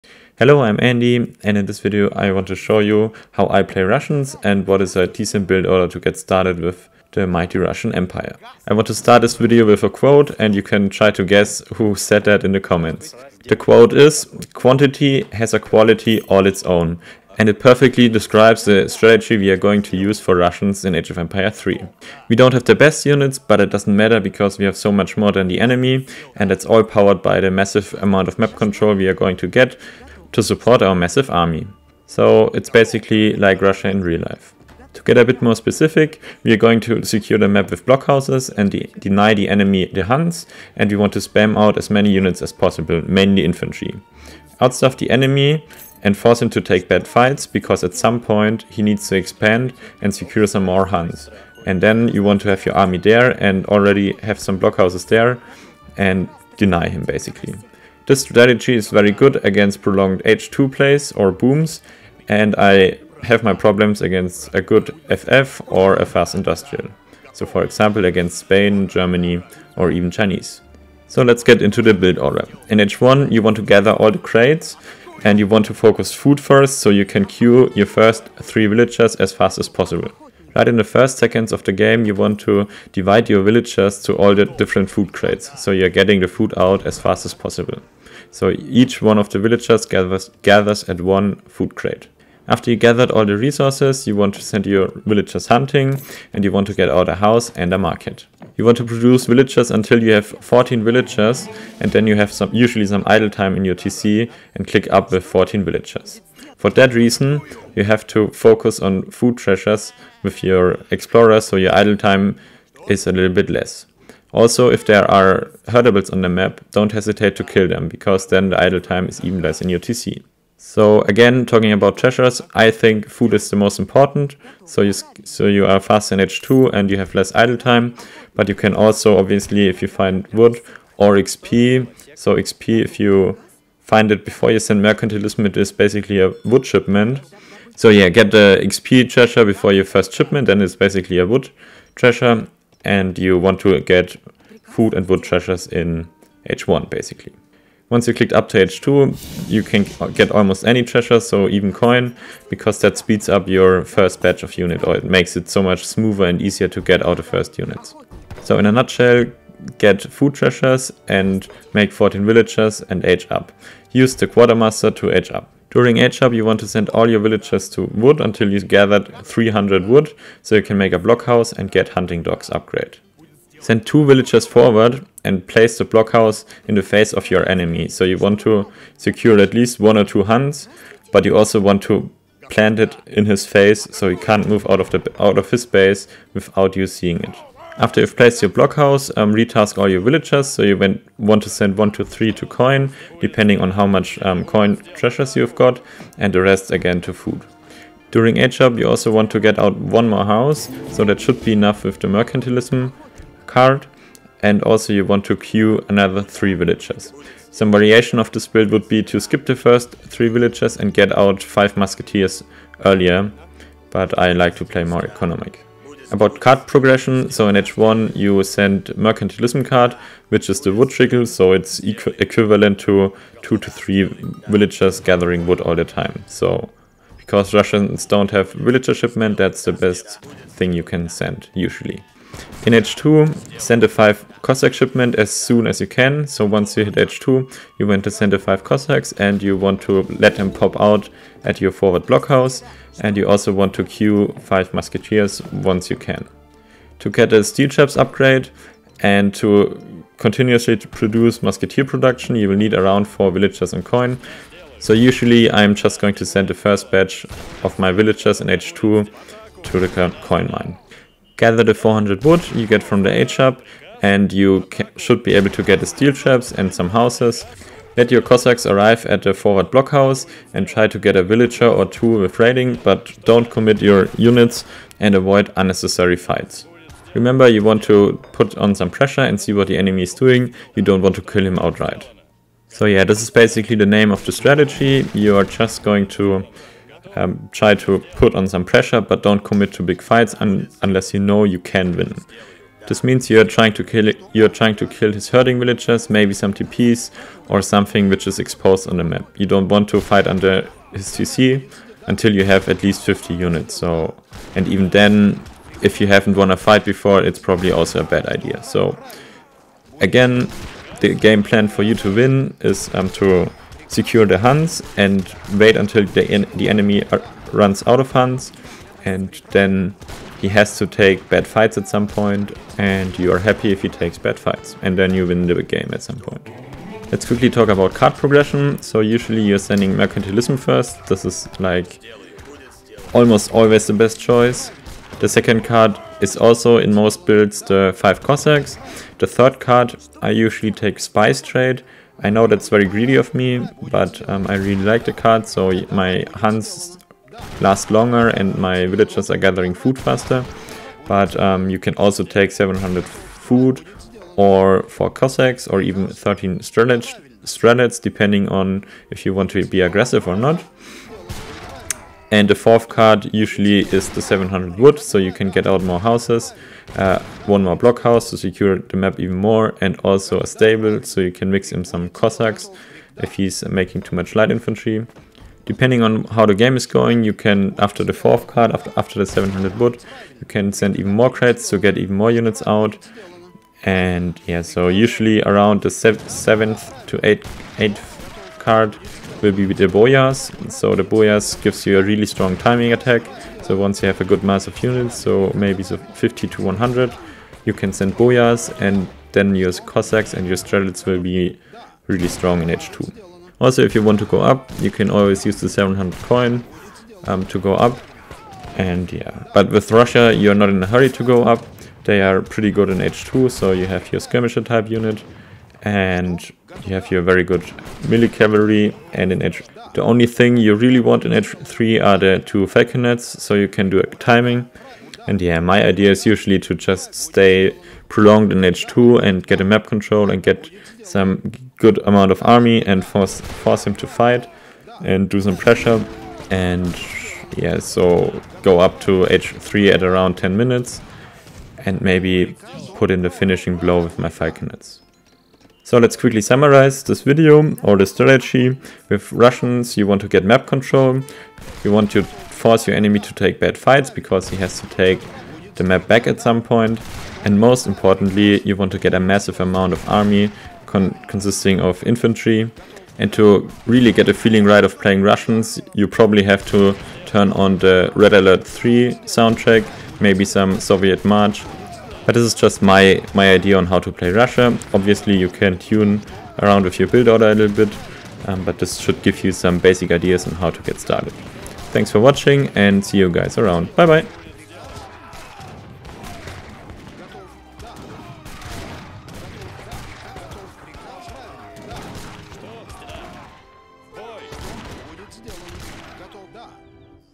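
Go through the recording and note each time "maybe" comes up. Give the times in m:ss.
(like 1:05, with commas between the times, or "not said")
4:56, 6:35, 7:22, 7:50.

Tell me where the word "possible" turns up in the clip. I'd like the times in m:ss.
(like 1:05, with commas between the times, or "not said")
0:42, 1:19, 1:27.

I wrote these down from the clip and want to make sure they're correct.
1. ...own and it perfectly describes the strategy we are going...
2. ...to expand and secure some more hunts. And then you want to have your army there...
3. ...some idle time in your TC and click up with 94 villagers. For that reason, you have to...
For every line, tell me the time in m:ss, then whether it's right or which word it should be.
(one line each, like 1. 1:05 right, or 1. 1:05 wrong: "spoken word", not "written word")
1. 0:16 right
2. 0:49 right
3. 1:42 wrong: "14", not "94".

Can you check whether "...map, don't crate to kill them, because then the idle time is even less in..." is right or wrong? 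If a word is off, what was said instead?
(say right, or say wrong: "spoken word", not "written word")
wrong: "hesitate", not "crate".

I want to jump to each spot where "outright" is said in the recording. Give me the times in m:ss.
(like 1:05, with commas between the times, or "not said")
4:41.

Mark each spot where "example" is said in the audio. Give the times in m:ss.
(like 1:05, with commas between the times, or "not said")
1:07.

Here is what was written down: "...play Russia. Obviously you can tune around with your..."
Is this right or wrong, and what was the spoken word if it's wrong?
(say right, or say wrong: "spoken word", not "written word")
right.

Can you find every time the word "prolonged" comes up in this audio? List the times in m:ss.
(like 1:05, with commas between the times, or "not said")
0:59, 7:08.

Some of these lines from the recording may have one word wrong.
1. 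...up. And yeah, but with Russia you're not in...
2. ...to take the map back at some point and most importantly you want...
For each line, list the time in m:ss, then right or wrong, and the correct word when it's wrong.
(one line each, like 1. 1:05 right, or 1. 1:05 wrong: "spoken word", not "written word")
1. 6:47 right
2. 7:34 right.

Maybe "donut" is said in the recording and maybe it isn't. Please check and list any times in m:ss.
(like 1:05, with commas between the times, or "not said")
not said.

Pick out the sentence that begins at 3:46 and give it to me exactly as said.
So because Russians don't have villager shipment, that's the best thing you can send, usually.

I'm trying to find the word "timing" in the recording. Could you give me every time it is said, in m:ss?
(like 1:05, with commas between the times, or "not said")
6:32, 7:04.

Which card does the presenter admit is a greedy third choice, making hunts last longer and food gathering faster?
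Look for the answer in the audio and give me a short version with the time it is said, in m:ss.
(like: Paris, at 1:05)
Spice Trade, at 5:40.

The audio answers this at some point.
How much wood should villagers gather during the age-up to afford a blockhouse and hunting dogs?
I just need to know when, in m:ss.
2:49.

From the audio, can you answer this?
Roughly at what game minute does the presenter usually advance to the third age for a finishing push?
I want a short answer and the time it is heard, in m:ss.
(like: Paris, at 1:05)
10 minutes, at 7:20.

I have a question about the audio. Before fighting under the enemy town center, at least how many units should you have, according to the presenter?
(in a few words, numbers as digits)
50.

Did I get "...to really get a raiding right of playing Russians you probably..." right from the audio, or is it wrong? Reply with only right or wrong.
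wrong.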